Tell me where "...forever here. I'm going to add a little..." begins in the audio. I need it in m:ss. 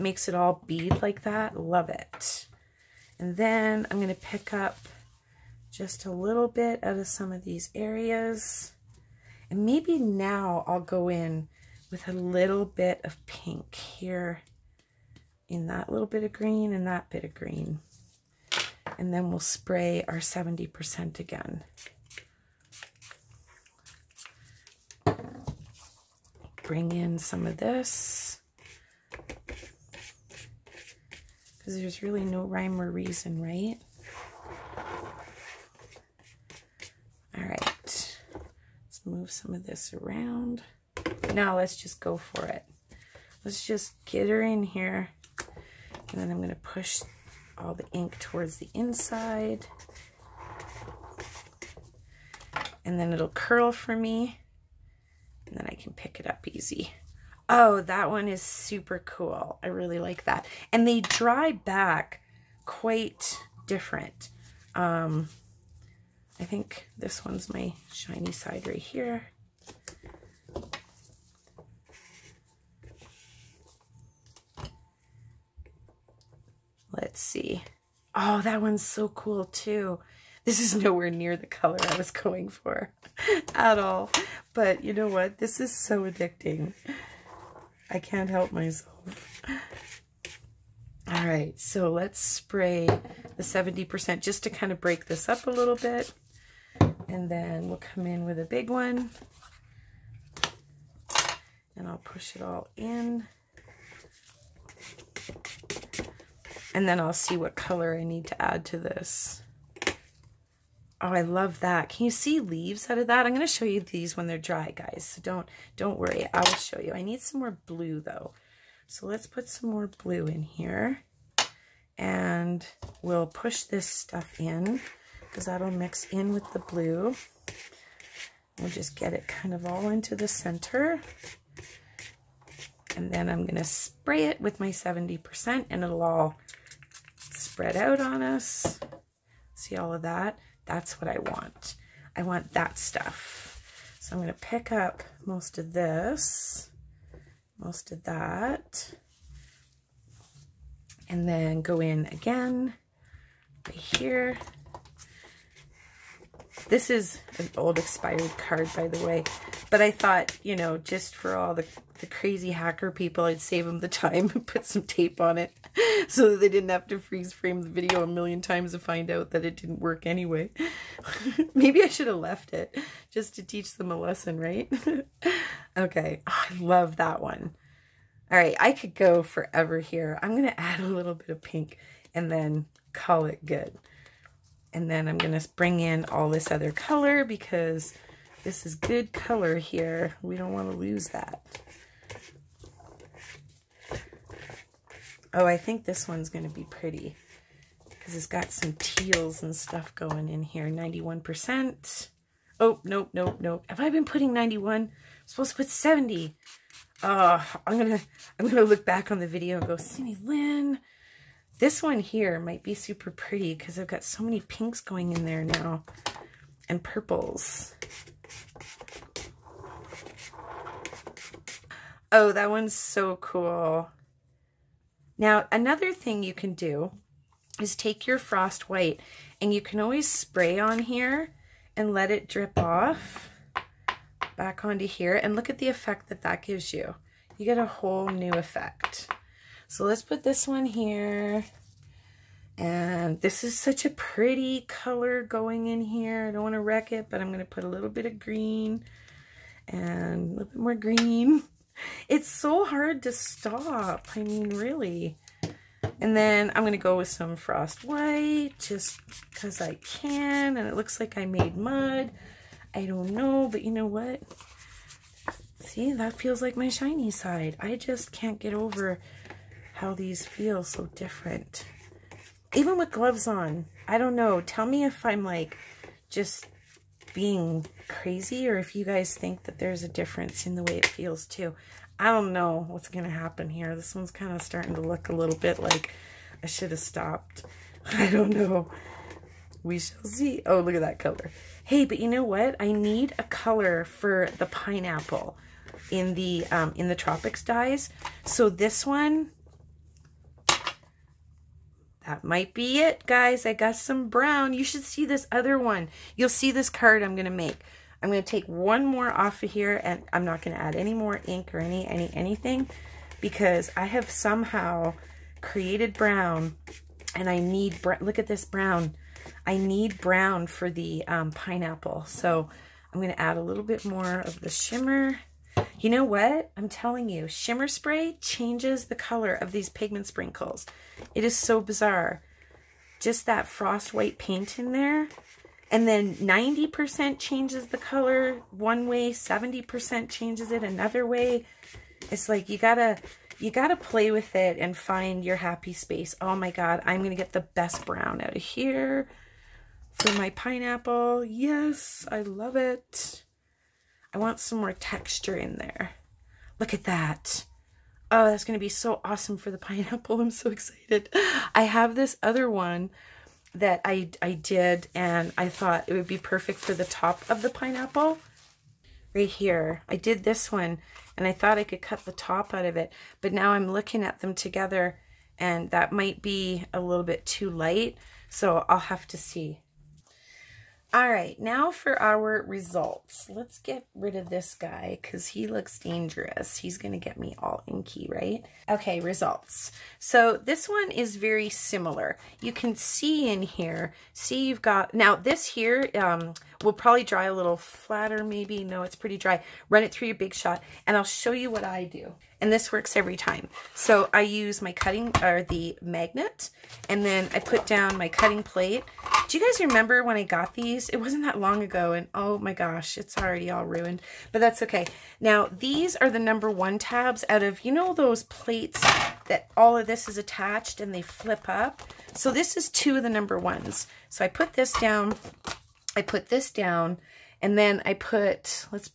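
2:59.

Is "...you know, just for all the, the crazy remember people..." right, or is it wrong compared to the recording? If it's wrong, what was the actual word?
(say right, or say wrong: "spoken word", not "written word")
wrong: "hacker", not "remember".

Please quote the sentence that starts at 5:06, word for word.
You'll see this card I'm going to make.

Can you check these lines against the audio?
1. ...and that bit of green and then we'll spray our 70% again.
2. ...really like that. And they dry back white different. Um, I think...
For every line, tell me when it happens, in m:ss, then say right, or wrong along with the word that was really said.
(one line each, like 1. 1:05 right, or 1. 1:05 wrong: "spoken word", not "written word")
1. 0:16 right
2. 0:59 wrong: "quite", not "white".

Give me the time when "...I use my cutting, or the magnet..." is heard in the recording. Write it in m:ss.
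6:44.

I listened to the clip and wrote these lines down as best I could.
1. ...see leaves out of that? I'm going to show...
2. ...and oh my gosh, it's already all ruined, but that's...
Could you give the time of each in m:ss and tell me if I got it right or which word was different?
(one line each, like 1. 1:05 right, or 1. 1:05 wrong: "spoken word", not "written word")
1. 1:52 right
2. 6:51 right.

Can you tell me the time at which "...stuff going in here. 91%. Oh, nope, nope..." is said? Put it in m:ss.
3:19.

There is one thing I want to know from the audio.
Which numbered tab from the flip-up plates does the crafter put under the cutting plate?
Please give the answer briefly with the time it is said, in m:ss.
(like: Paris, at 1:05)
number one, at 7:03.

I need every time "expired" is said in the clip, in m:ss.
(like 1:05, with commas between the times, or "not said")
2:37.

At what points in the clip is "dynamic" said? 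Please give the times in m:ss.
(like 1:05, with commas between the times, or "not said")
not said.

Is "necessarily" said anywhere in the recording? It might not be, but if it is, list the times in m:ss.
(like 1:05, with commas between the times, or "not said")
not said.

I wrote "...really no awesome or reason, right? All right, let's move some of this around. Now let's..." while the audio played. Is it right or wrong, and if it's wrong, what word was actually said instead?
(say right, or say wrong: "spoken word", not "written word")
wrong: "rhyme", not "awesome".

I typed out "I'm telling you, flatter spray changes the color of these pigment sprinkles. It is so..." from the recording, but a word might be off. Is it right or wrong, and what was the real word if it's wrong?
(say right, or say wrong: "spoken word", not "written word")
wrong: "shimmer", not "flatter".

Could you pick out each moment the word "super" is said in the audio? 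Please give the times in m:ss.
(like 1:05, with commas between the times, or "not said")
0:58, 3:32.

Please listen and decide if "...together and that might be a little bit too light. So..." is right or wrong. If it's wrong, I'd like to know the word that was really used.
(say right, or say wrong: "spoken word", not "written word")
right.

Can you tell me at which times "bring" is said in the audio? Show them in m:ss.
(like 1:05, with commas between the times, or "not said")
0:26, 3:05.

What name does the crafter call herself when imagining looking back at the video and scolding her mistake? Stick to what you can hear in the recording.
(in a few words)
Cindy Lynn.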